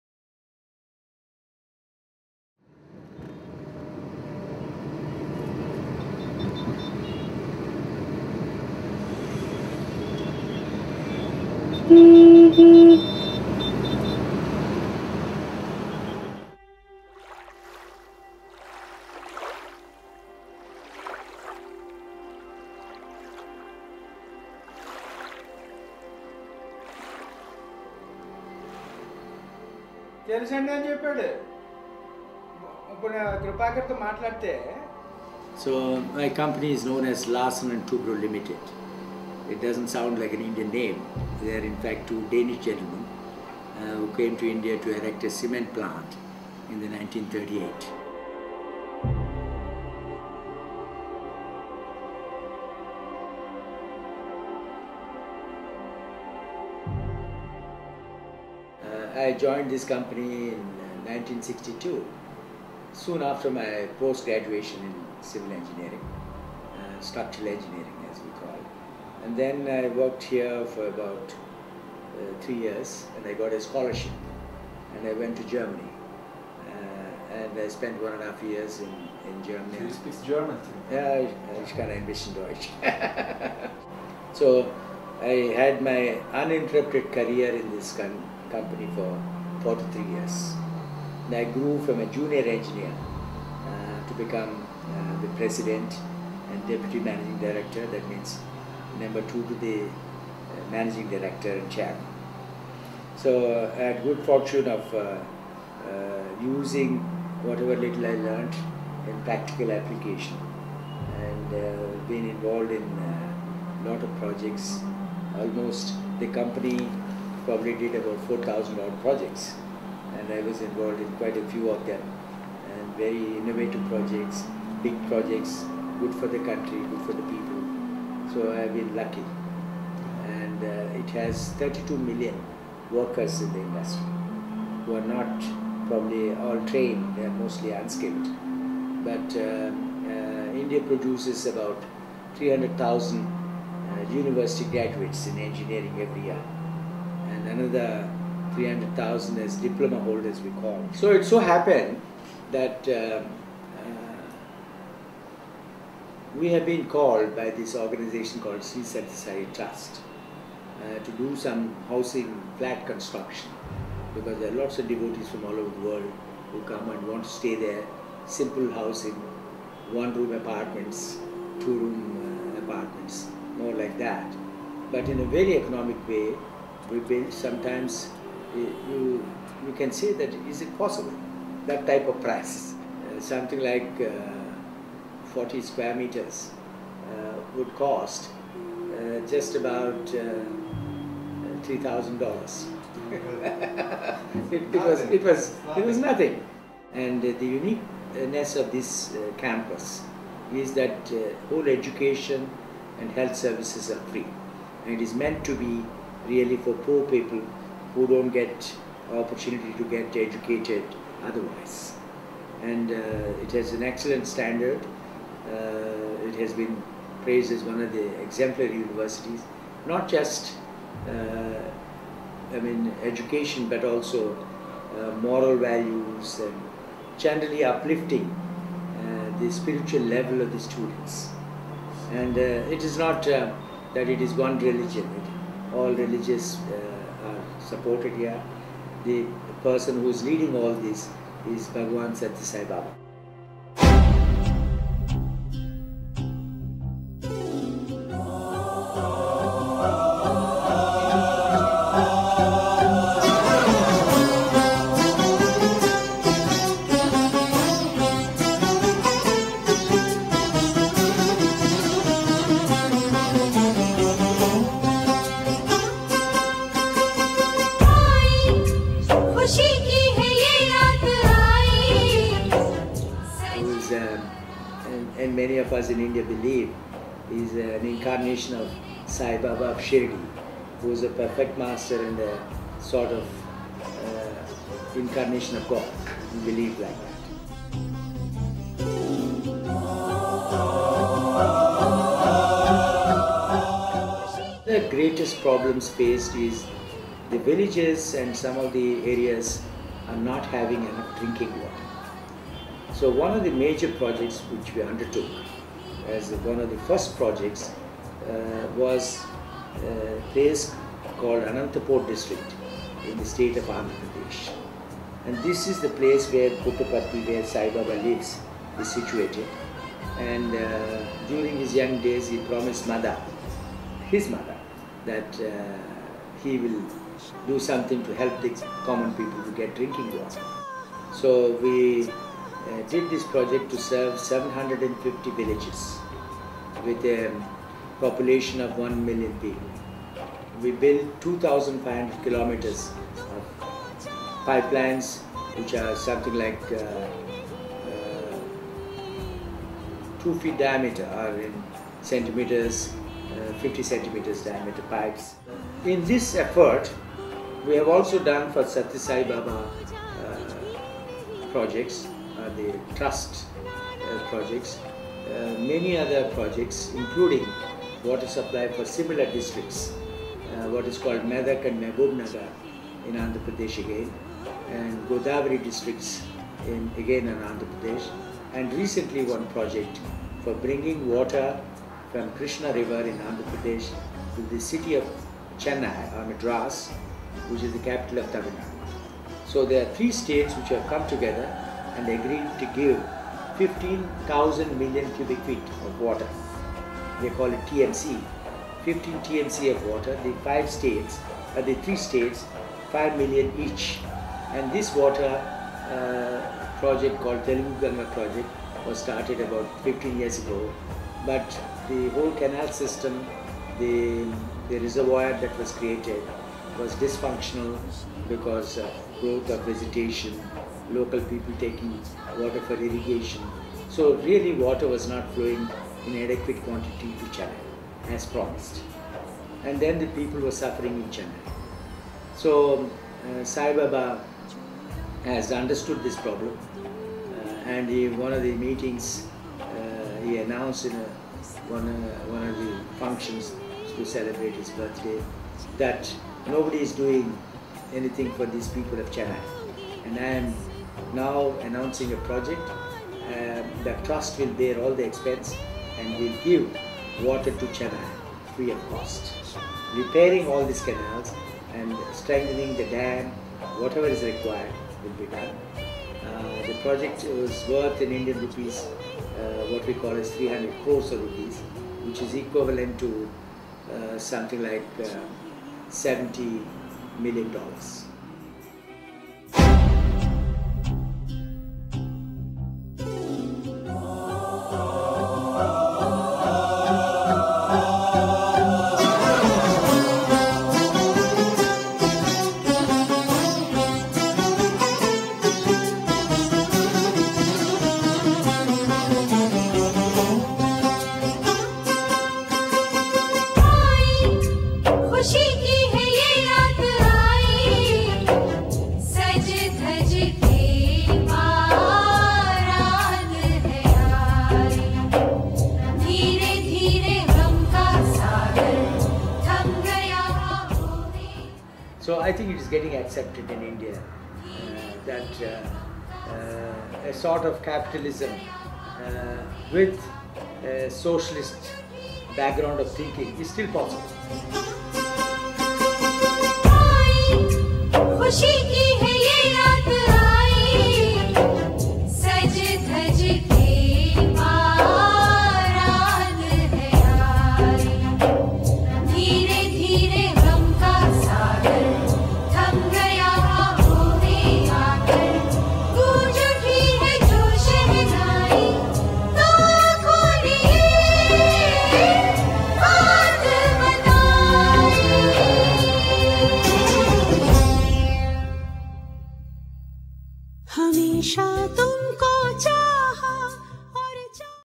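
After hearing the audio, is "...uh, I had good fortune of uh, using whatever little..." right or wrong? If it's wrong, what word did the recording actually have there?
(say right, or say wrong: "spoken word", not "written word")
right.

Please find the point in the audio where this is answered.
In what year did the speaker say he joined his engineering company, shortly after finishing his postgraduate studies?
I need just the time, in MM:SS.
01:01.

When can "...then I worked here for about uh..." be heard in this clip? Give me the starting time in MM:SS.
01:09.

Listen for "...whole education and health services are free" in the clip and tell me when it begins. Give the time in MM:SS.
03:21.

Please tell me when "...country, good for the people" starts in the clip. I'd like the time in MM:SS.
02:06.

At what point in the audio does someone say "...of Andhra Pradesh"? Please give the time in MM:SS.
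05:13.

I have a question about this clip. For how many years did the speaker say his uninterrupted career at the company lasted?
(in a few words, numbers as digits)
43 years.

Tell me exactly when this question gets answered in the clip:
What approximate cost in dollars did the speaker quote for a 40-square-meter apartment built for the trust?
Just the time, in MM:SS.
03:11.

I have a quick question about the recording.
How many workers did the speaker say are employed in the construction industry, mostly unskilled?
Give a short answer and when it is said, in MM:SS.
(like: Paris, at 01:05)
32 million, at 02:11.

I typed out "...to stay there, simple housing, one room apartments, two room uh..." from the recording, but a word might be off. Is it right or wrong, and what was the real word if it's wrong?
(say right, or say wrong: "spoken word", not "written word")
right.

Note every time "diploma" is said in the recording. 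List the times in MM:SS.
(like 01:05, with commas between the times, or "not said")
02:29.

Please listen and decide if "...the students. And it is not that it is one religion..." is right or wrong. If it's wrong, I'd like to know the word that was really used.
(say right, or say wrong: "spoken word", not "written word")
right.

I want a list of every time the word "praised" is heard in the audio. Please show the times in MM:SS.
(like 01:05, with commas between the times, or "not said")
03:37.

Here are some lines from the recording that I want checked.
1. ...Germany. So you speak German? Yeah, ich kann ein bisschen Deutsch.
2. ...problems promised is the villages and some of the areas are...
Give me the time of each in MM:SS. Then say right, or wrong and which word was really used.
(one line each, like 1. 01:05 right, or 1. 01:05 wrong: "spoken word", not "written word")
1. 01:19 right
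2. 04:55 wrong: "faced", not "promised".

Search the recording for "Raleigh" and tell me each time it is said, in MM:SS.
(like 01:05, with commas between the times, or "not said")
not said.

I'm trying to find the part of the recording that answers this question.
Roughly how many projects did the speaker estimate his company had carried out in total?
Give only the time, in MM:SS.
01:58.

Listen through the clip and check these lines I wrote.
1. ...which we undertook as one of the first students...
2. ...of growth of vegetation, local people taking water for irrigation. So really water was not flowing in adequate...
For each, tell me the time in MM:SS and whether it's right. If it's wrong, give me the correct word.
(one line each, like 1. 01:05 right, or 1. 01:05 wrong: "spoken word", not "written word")
1. 05:04 wrong: "projects", not "students"
2. 06:58 right.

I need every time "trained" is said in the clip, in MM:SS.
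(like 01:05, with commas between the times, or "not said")
02:16.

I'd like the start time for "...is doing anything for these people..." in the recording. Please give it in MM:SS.
07:26.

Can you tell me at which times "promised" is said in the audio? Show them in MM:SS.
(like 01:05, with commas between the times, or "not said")
05:22, 07:08.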